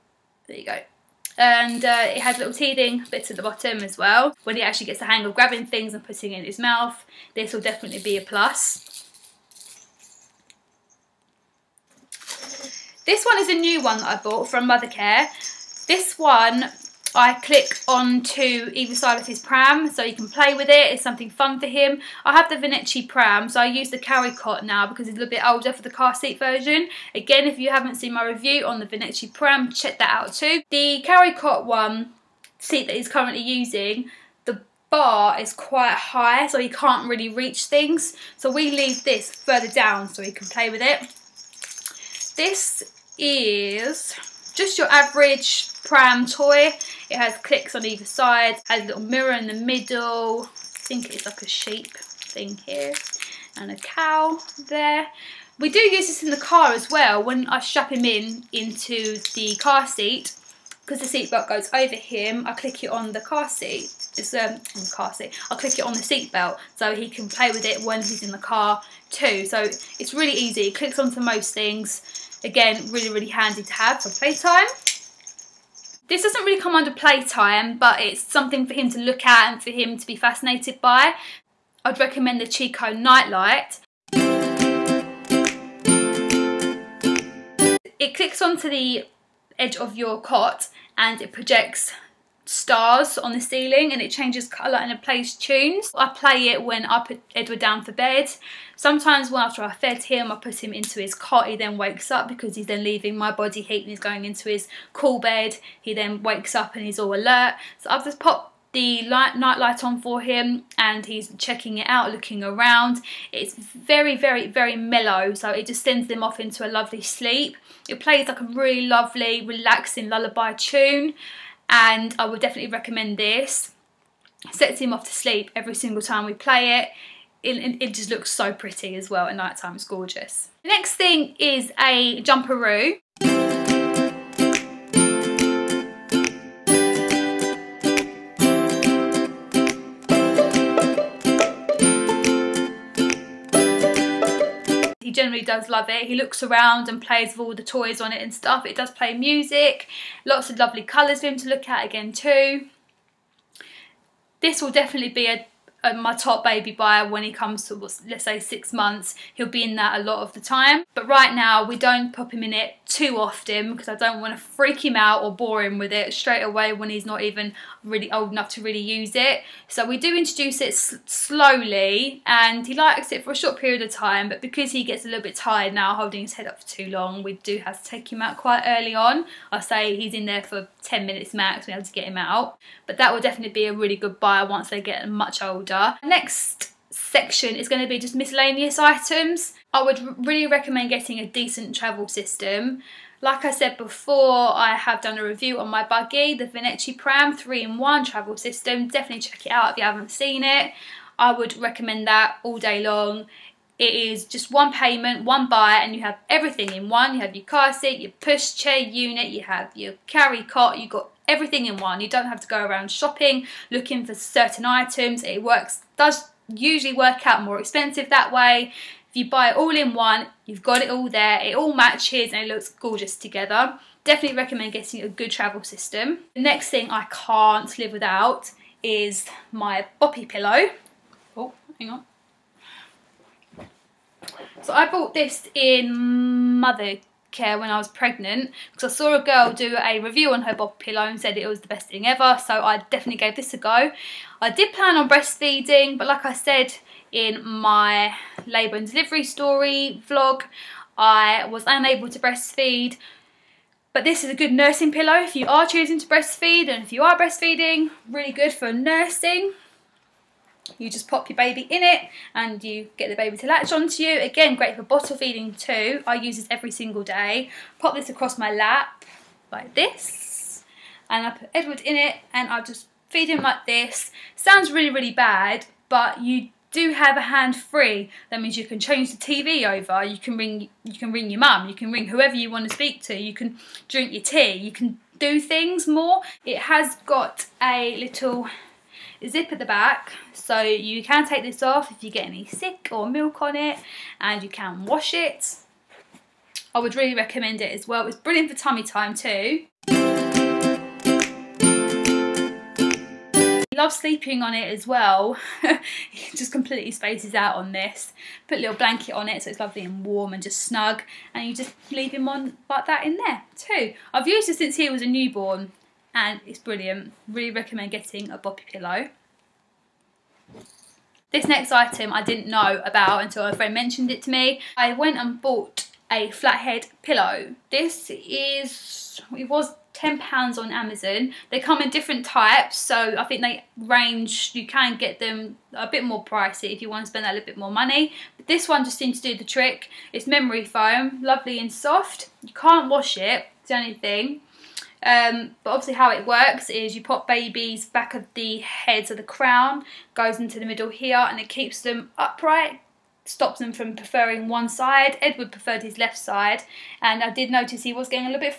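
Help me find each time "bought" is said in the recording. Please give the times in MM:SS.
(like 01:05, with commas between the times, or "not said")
00:14, 03:54, 05:25.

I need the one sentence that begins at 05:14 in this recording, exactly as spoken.
I've used it since he was a newborn and it's brilliant.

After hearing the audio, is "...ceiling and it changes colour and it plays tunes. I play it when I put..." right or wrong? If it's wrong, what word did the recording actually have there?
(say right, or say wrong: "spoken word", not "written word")
right.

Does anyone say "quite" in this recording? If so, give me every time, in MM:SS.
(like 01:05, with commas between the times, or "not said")
00:35, 02:58.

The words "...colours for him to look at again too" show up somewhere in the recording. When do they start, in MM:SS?
02:30.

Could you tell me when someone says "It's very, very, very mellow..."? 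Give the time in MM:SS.
01:53.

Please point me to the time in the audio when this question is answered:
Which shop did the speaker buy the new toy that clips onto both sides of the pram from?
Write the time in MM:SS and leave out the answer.
00:14.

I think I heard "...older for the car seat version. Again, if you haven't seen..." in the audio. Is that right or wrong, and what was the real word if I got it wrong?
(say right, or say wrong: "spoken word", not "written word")
right.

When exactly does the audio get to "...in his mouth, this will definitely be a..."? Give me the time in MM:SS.
00:06.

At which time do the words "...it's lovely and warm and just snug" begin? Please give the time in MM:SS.
05:09.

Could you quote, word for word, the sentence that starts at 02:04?
Sets him off to sleep every single time we play it.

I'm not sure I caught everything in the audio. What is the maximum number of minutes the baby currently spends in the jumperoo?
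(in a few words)
10.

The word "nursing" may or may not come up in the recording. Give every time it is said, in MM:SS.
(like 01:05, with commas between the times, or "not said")
04:14, 04:18.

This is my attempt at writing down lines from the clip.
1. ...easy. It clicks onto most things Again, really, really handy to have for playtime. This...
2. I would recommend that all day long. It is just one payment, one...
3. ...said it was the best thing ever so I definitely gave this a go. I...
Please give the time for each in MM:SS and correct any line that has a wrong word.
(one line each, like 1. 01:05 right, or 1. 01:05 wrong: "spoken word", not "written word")
1. 01:10 right
2. 03:21 right
3. 04:01 right.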